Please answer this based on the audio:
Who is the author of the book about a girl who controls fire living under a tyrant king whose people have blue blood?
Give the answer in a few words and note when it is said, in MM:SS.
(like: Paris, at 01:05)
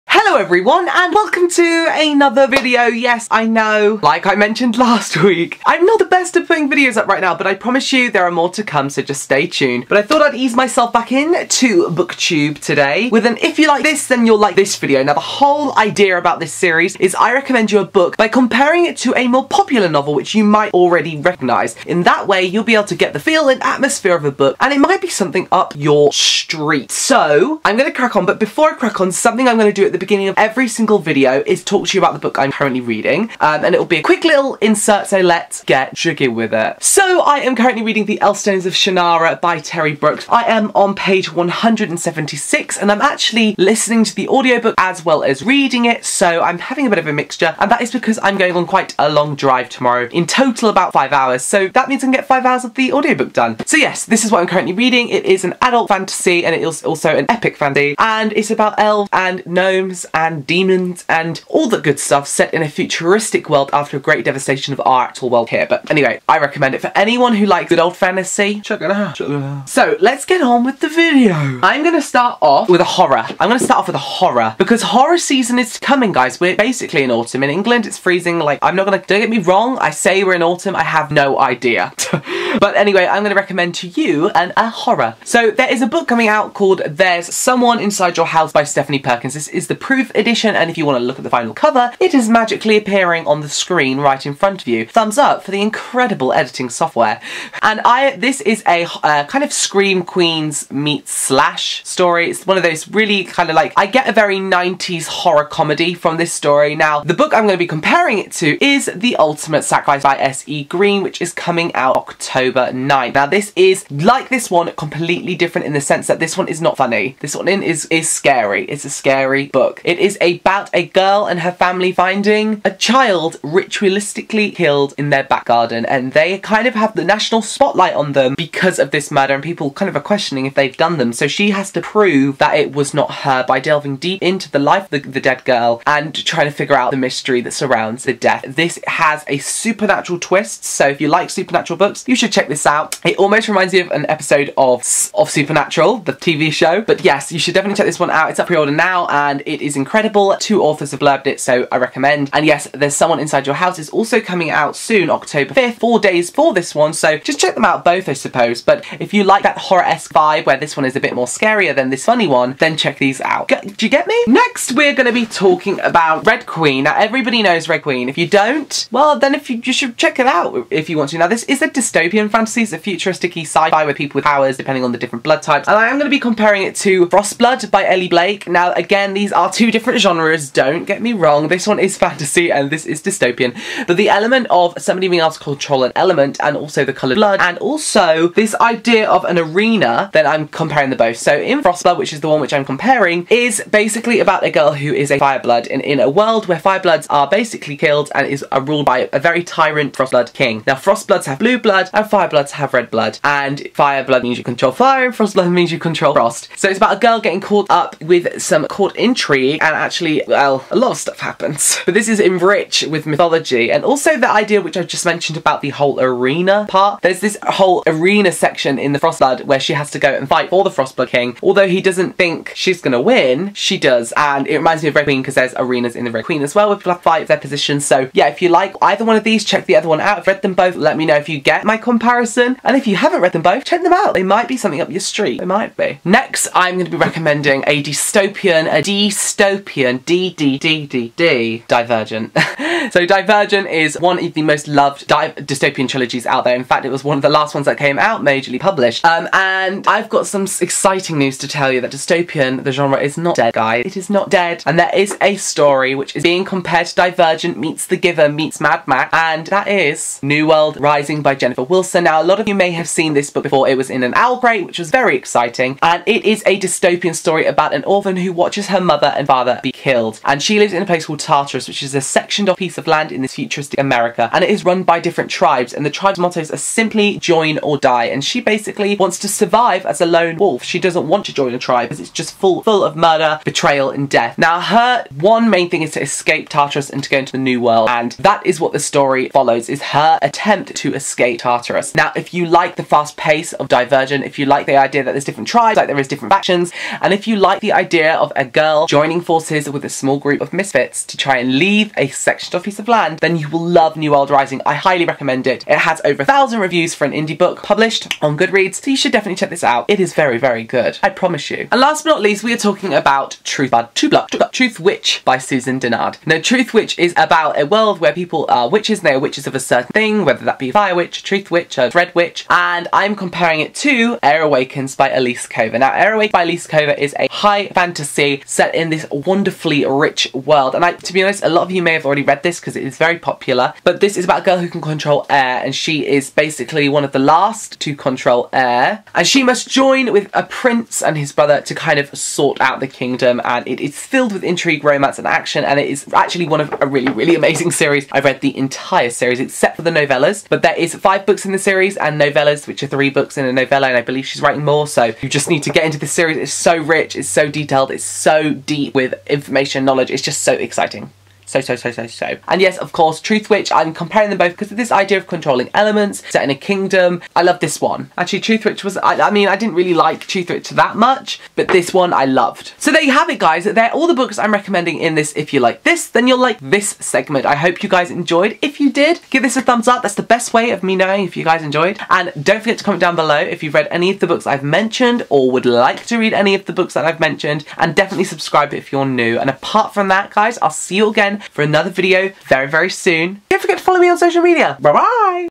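Elly Blake, at 02:57.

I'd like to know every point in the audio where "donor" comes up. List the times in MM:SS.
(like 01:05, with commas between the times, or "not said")
not said.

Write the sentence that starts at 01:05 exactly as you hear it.
But anyway, I recommend it for anyone who likes good old fantasy.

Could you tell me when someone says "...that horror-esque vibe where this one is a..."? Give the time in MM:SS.
02:39.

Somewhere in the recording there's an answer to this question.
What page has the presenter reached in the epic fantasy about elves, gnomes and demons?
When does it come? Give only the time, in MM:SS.
00:40.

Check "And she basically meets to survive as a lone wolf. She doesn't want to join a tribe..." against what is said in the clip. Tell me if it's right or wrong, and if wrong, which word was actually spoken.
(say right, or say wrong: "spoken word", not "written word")
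wrong: "wants", not "meets".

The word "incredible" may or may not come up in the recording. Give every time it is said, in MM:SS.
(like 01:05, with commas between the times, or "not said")
01:35, 02:29.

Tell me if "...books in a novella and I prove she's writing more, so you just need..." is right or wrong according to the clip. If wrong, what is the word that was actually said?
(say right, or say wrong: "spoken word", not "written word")
wrong: "believe", not "prove".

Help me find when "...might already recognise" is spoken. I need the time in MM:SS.
00:20.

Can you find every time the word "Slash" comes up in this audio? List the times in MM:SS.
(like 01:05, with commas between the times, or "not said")
01:41.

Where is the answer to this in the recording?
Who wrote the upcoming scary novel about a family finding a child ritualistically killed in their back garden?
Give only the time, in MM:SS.
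01:50.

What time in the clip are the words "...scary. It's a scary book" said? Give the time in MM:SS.
01:58.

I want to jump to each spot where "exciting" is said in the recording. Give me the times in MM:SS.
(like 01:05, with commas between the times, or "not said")
04:10, 04:25, 06:00.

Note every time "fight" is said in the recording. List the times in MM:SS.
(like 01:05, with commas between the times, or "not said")
03:40, 03:46.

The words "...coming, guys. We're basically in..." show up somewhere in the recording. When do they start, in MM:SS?
01:15.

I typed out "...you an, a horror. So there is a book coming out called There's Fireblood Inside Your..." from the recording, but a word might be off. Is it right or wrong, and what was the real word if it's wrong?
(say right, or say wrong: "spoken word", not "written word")
wrong: "Someone", not "Fireblood".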